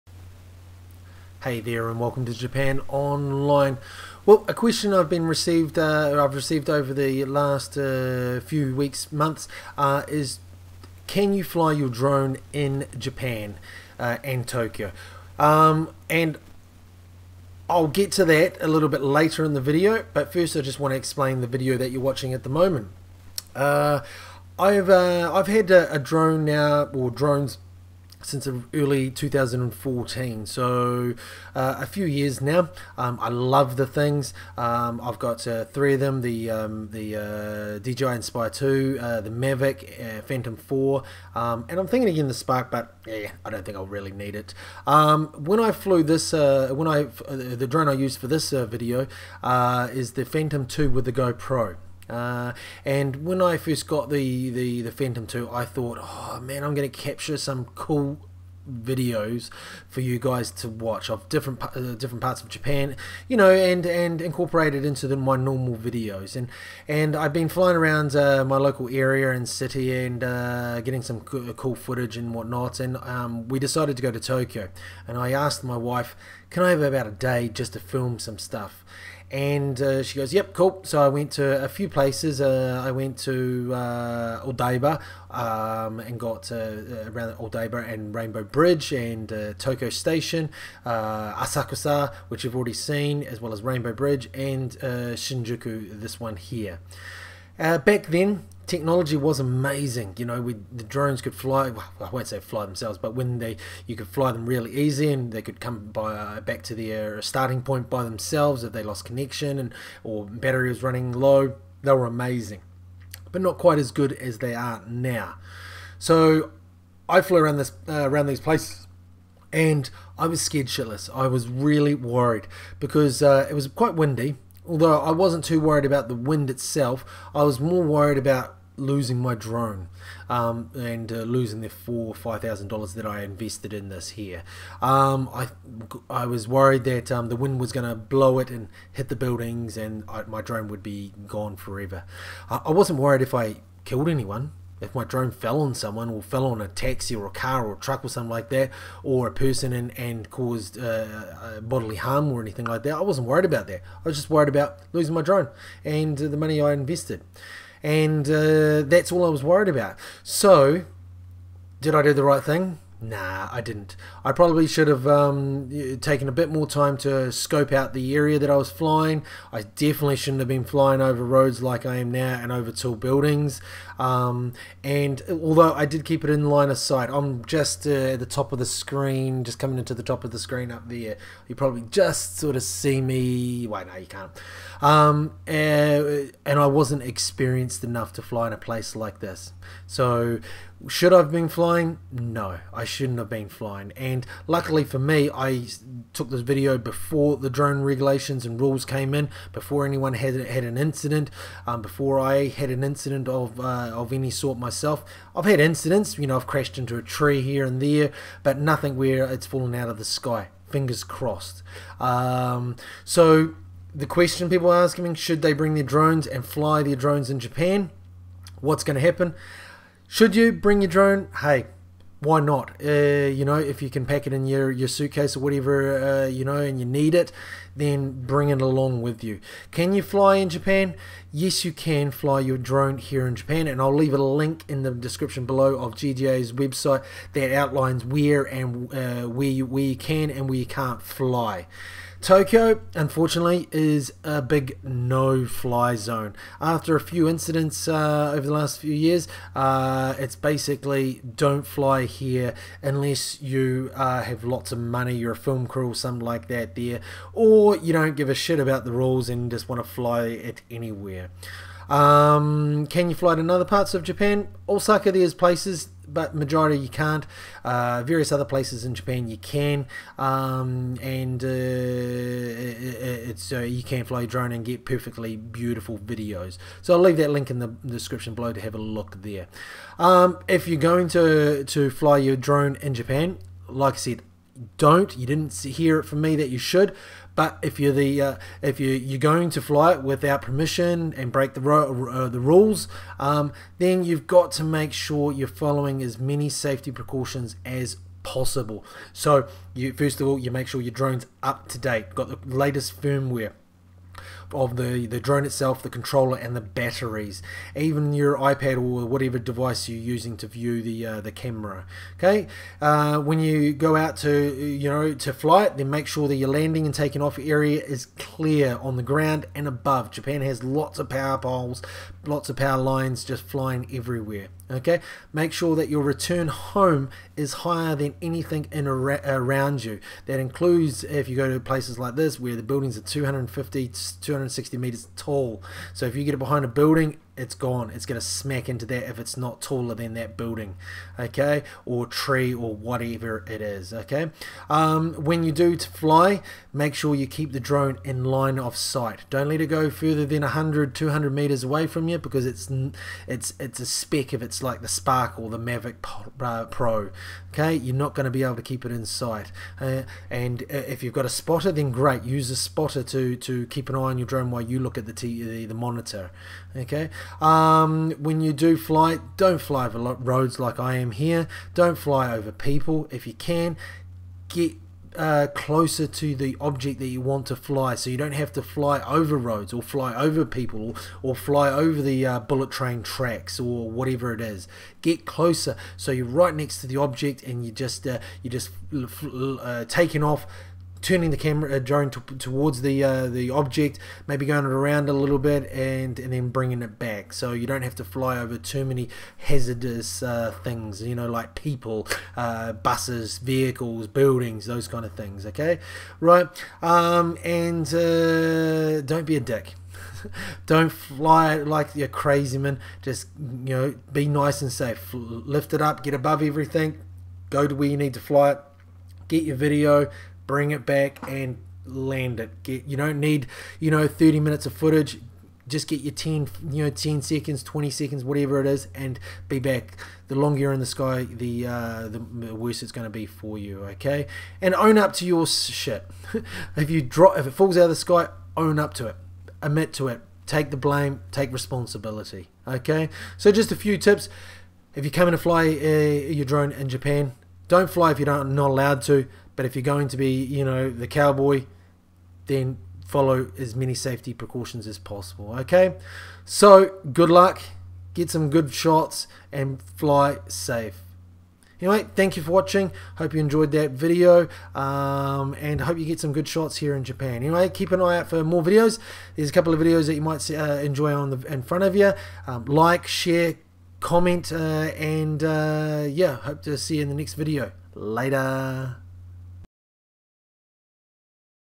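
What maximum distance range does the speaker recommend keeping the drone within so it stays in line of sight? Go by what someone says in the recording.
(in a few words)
100 to 200 meters.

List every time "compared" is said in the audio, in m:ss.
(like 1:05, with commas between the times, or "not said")
not said.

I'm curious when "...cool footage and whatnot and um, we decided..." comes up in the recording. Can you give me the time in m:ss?
1:11.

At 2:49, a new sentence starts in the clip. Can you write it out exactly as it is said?
I definitely shouldn't have been flying over roads like I am now and over tall buildings.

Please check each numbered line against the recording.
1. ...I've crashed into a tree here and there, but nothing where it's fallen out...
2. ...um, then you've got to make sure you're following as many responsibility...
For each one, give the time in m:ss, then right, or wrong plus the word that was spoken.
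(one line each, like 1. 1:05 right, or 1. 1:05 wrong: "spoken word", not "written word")
1. 3:26 right
2. 4:53 wrong: "safety", not "responsibility".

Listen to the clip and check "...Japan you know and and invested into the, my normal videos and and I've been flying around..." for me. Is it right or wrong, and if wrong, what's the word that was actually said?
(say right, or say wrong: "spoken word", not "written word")
wrong: "incorporated", not "invested".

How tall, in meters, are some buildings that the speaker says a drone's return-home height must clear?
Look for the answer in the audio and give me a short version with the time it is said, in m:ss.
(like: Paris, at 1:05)
250 to 260 meters, at 5:33.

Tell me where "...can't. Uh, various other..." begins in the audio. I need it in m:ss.
4:26.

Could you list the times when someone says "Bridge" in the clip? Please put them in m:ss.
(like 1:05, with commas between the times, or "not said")
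1:28, 1:33.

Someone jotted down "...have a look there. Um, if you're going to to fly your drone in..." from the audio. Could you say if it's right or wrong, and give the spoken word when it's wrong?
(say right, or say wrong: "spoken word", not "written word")
right.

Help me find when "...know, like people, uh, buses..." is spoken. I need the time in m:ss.
6:41.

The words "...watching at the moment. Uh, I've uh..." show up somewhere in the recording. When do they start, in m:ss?
0:22.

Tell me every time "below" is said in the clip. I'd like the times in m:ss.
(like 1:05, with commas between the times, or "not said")
3:55, 4:38.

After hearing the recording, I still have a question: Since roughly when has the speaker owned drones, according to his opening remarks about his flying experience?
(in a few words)
early 2014.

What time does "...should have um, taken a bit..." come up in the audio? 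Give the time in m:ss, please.
2:44.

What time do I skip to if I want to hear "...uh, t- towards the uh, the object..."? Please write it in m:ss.
6:31.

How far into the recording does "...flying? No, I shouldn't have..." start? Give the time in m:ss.
3:11.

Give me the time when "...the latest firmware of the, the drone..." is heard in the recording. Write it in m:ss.
5:02.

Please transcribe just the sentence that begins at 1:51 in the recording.
They were amazing, but not quite as good as they are now.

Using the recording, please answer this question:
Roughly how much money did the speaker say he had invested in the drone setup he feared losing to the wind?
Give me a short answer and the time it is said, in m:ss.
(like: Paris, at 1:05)
4,000 or 5,000 dollars, at 2:11.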